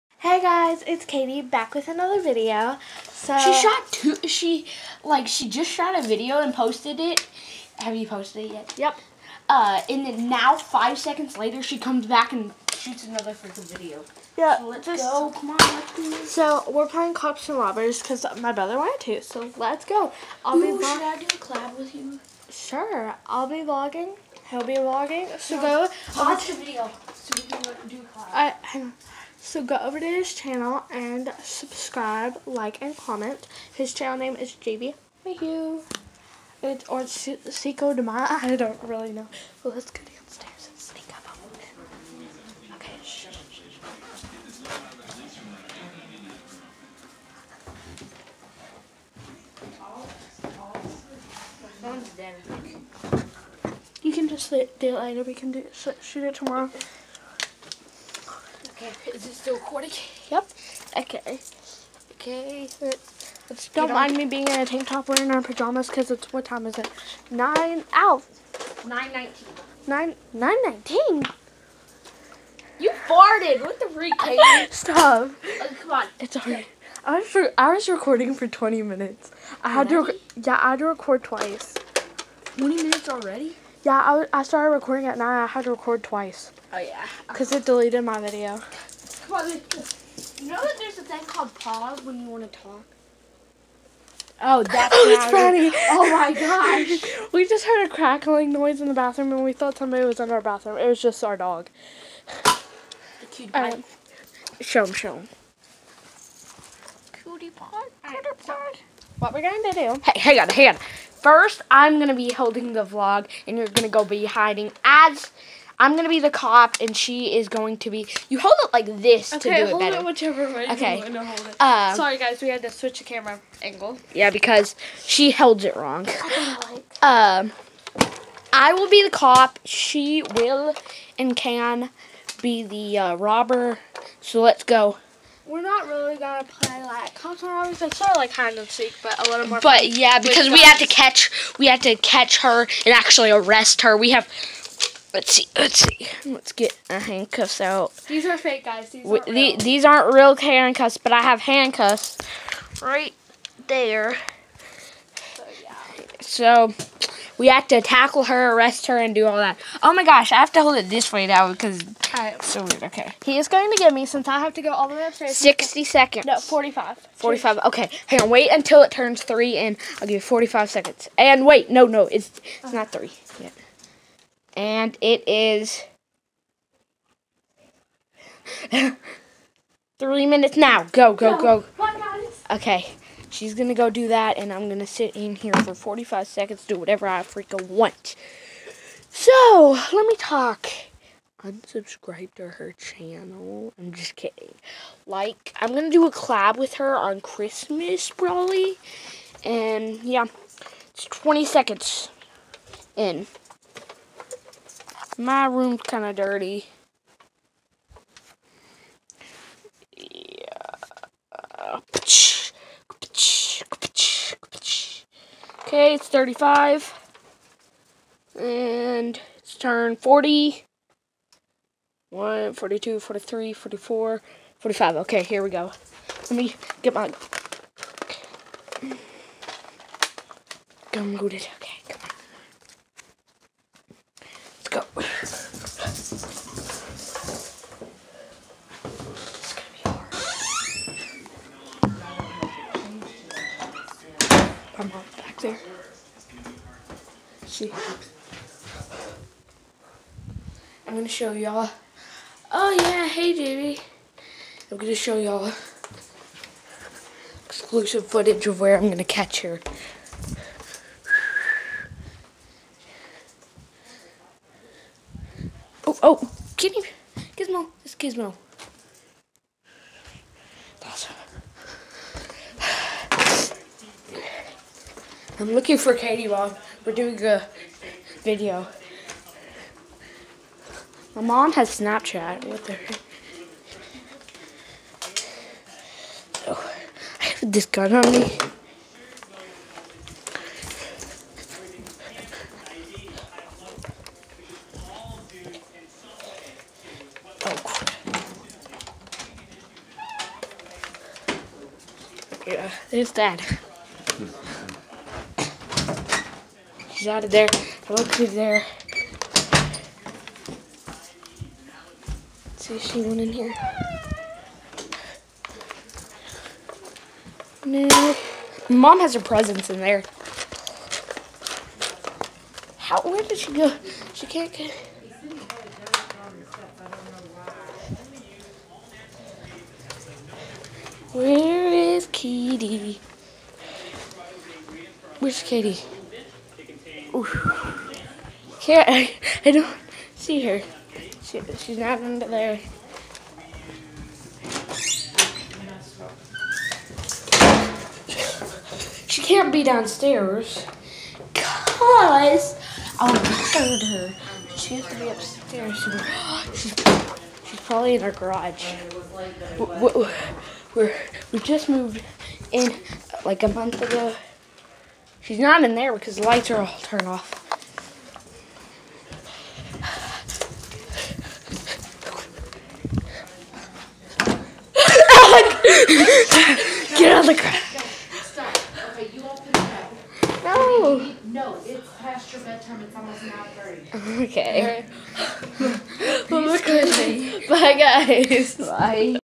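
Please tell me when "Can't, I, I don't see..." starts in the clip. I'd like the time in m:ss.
5:37.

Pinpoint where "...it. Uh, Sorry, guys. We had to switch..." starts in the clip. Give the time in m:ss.
2:01.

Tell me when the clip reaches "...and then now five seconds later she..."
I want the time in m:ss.
0:09.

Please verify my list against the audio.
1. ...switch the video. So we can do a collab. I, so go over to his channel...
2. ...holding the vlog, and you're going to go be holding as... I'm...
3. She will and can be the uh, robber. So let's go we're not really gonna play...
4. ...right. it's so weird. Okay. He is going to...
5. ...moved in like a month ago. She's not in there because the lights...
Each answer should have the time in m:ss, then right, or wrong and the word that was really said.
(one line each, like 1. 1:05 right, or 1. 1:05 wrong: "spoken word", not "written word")
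1. 0:26 wrong: "watch", not "switch"
2. 1:52 wrong: "hiding", not "holding"
3. 2:09 right
4. 2:42 right
5. 6:01 right.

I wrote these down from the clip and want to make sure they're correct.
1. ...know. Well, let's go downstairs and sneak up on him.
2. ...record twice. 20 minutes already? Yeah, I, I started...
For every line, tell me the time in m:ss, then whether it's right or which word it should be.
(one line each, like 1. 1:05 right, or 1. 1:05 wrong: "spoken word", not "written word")
1. 0:39 right
2. 1:20 right.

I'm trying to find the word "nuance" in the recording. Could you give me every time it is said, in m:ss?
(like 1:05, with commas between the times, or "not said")
not said.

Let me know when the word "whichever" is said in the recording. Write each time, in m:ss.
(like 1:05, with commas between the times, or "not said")
2:00.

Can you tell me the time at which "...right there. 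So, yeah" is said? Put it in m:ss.
2:32.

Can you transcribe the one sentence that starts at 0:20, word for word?
I'll Ooh, be should I do a collab with you?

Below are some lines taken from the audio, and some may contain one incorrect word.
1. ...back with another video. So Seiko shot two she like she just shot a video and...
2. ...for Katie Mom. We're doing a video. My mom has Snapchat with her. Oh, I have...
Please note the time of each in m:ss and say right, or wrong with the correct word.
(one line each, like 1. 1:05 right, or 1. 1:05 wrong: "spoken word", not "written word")
1. 0:01 wrong: "She", not "Seiko"
2. 4:35 right.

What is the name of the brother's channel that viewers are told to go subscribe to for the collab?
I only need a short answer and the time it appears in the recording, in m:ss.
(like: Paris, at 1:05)
JB Mayhew, at 0:34.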